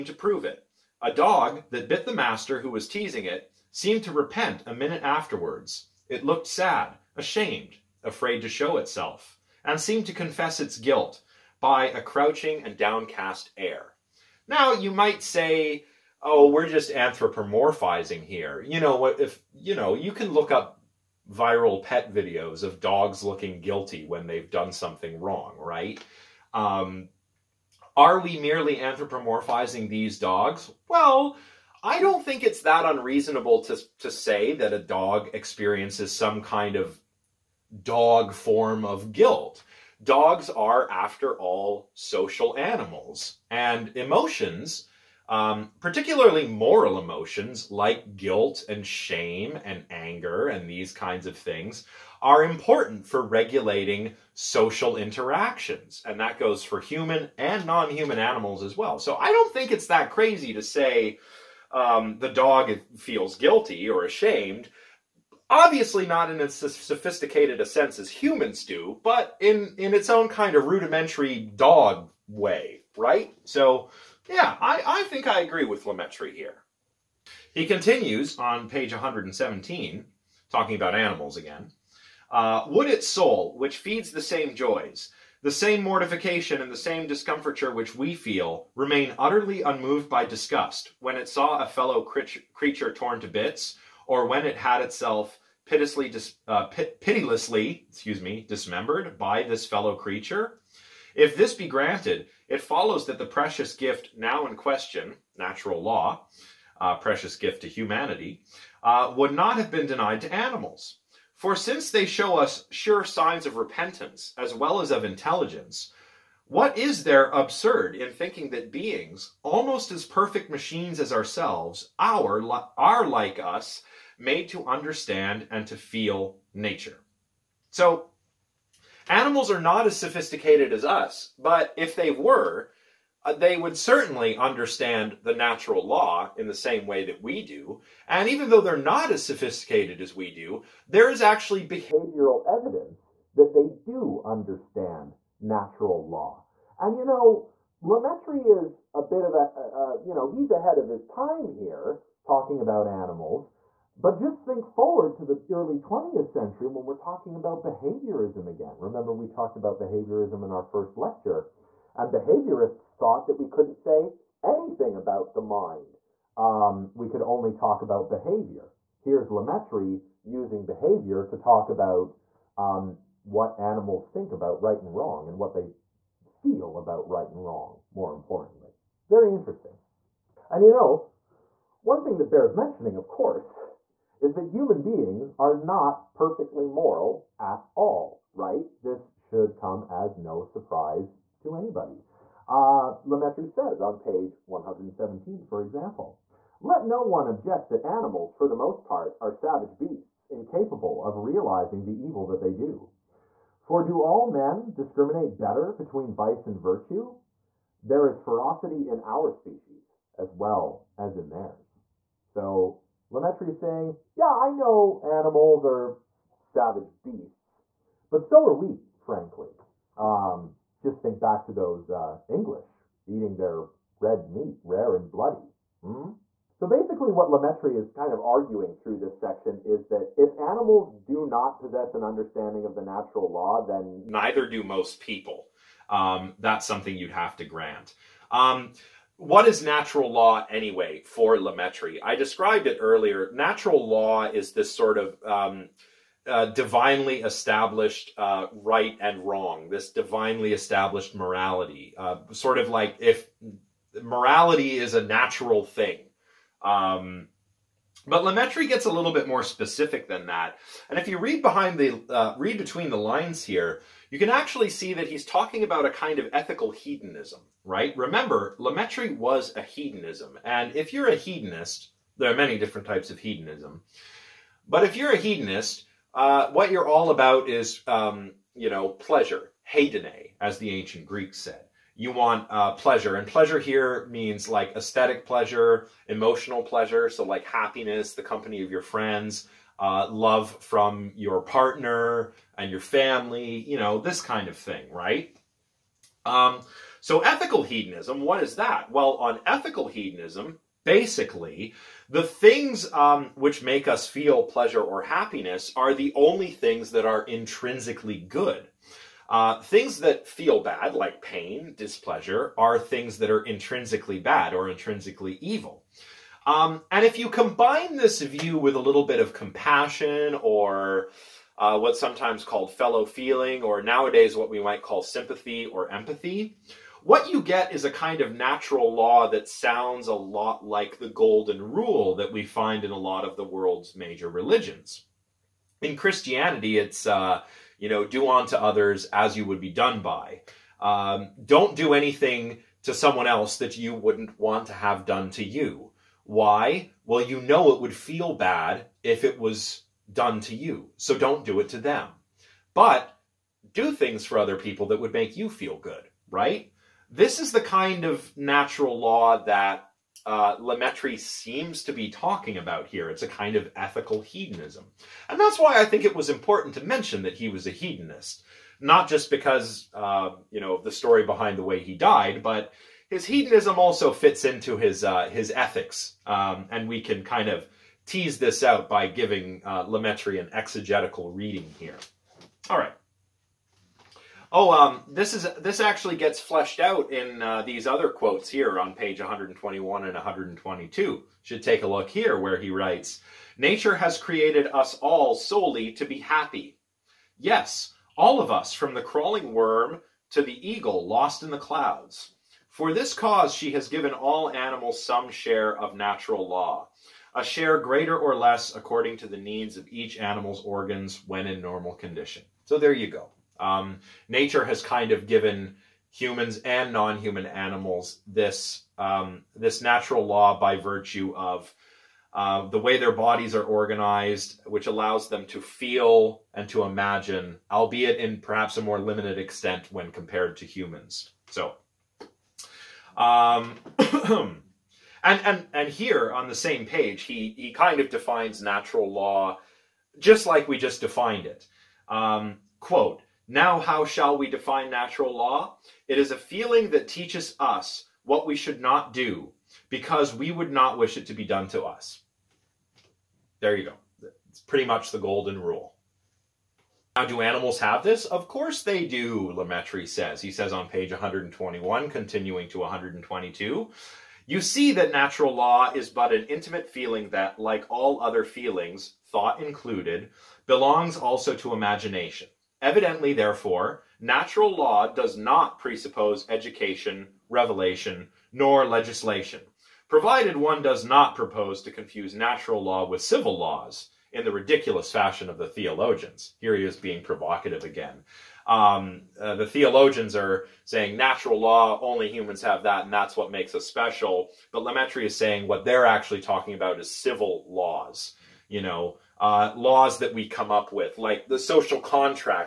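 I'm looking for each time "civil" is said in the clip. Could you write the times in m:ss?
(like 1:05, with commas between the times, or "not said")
8:03, 8:17.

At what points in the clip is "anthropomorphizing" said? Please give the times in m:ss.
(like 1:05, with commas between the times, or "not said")
0:16, 0:28.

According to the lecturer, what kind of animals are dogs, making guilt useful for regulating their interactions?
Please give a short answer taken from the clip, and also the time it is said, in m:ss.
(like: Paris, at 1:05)
social animals, at 0:41.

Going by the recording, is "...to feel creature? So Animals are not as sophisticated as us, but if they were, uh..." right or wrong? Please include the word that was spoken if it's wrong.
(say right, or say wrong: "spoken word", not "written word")
wrong: "nature", not "creature".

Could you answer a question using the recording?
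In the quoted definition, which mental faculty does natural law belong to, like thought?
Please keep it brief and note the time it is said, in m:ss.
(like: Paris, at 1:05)
imagination, at 7:51.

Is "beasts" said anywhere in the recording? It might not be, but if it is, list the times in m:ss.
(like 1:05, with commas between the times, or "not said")
3:19, 3:37.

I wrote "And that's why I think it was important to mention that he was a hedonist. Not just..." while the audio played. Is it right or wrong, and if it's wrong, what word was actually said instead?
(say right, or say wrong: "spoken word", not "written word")
right.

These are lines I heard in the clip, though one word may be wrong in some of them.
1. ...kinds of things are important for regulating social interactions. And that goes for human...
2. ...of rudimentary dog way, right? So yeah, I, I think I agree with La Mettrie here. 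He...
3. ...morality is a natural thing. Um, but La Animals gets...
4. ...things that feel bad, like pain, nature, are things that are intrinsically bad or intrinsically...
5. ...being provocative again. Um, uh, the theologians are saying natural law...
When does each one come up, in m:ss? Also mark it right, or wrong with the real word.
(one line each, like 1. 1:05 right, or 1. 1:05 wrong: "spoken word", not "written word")
1. 0:50 right
2. 1:10 right
3. 4:14 wrong: "Mettrie", not "Animals"
4. 5:09 wrong: "displeasure", not "nature"
5. 8:06 right.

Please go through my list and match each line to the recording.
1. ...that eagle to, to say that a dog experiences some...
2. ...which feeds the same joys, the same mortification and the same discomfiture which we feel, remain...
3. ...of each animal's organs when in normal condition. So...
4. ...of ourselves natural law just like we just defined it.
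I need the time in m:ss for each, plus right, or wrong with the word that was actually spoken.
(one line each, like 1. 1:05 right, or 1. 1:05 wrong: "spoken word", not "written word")
1. 0:32 wrong: "unreasonable", not "eagle"
2. 1:23 right
3. 6:49 right
4. 7:18 wrong: "defines", not "ourselves".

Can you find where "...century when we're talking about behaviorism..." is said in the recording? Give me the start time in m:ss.
2:36.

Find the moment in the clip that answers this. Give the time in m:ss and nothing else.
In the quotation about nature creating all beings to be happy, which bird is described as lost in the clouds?
6:40.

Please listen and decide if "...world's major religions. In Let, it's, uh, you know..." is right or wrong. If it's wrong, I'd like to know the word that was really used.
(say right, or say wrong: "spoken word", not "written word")
wrong: "Christianity", not "Let".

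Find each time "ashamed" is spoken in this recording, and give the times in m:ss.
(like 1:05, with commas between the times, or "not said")
0:07, 1:04.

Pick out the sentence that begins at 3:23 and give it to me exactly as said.
For do all men discriminate better between vice and virtue?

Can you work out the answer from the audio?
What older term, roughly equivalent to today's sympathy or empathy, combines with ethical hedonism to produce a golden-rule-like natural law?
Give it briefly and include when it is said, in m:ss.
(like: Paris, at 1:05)
fellow feeling, at 5:22.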